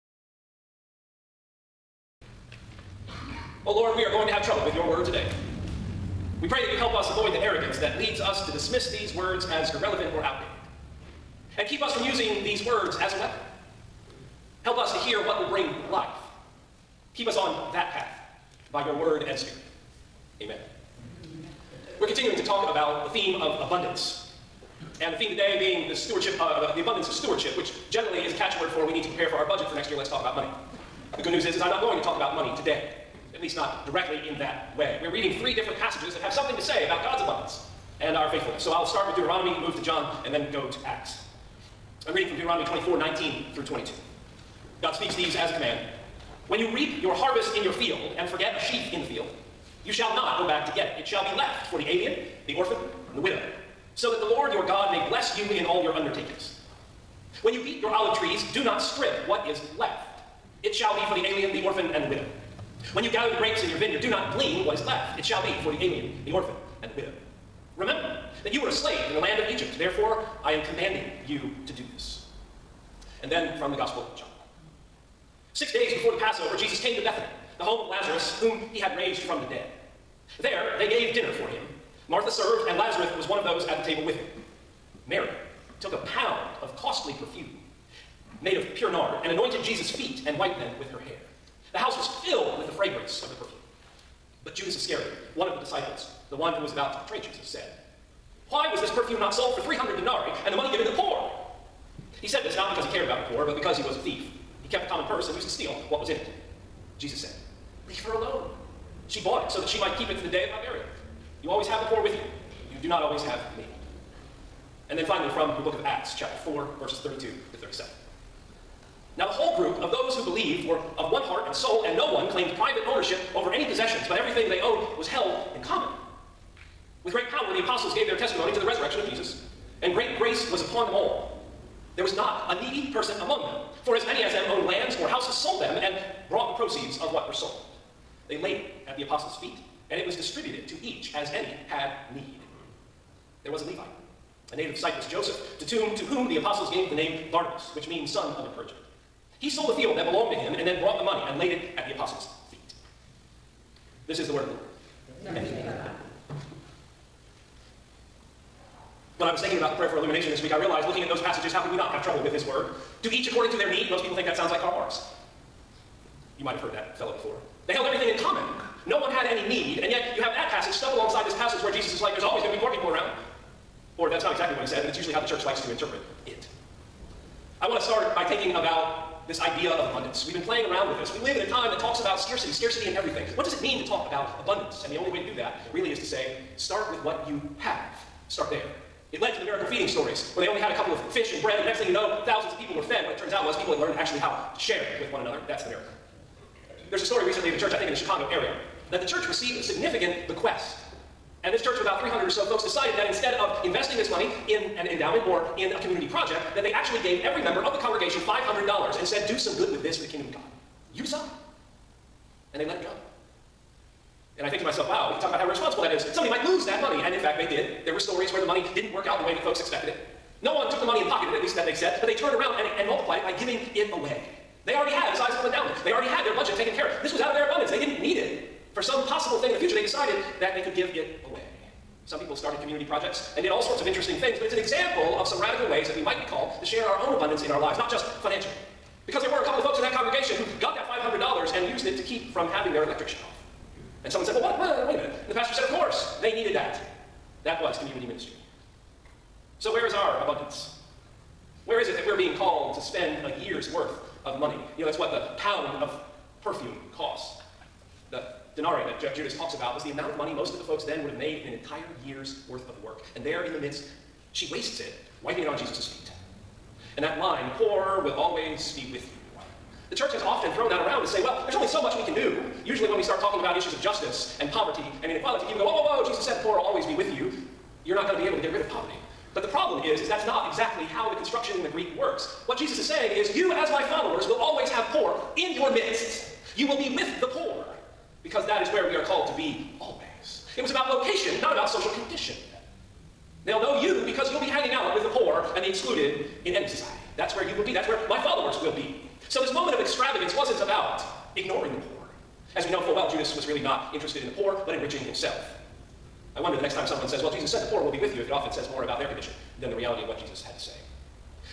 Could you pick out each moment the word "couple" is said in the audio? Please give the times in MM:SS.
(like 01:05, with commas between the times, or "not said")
03:10, 03:59.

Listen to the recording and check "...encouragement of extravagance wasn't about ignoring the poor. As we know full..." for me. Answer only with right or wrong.
wrong.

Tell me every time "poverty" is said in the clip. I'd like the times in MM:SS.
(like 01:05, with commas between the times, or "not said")
04:34, 04:38.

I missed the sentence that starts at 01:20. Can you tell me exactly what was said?
There, they gave dinner for him.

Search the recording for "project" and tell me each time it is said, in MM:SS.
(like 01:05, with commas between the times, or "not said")
03:26, 03:52.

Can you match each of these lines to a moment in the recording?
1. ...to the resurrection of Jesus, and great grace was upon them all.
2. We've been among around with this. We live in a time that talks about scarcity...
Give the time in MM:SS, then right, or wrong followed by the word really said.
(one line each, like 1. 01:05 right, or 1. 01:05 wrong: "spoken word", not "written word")
1. 02:08 right
2. 03:00 wrong: "playing", not "among".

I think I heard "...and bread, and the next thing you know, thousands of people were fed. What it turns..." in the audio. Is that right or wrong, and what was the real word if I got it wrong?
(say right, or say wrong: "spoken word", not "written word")
right.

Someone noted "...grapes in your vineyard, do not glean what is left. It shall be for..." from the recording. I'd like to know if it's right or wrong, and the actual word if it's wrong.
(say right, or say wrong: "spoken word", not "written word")
right.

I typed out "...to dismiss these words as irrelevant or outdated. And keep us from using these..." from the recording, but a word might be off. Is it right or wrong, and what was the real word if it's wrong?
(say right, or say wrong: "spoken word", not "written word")
right.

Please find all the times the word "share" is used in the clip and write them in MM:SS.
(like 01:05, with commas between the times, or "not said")
03:14, 03:56.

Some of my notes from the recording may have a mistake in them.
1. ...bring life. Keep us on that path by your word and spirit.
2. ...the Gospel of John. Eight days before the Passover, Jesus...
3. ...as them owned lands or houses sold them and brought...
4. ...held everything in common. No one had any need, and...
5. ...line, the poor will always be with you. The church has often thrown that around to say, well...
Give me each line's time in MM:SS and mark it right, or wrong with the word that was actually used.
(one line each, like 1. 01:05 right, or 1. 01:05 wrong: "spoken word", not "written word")
1. 00:15 right
2. 01:13 wrong: "Six", not "Eight"
3. 02:14 right
4. 02:47 right
5. 04:27 right.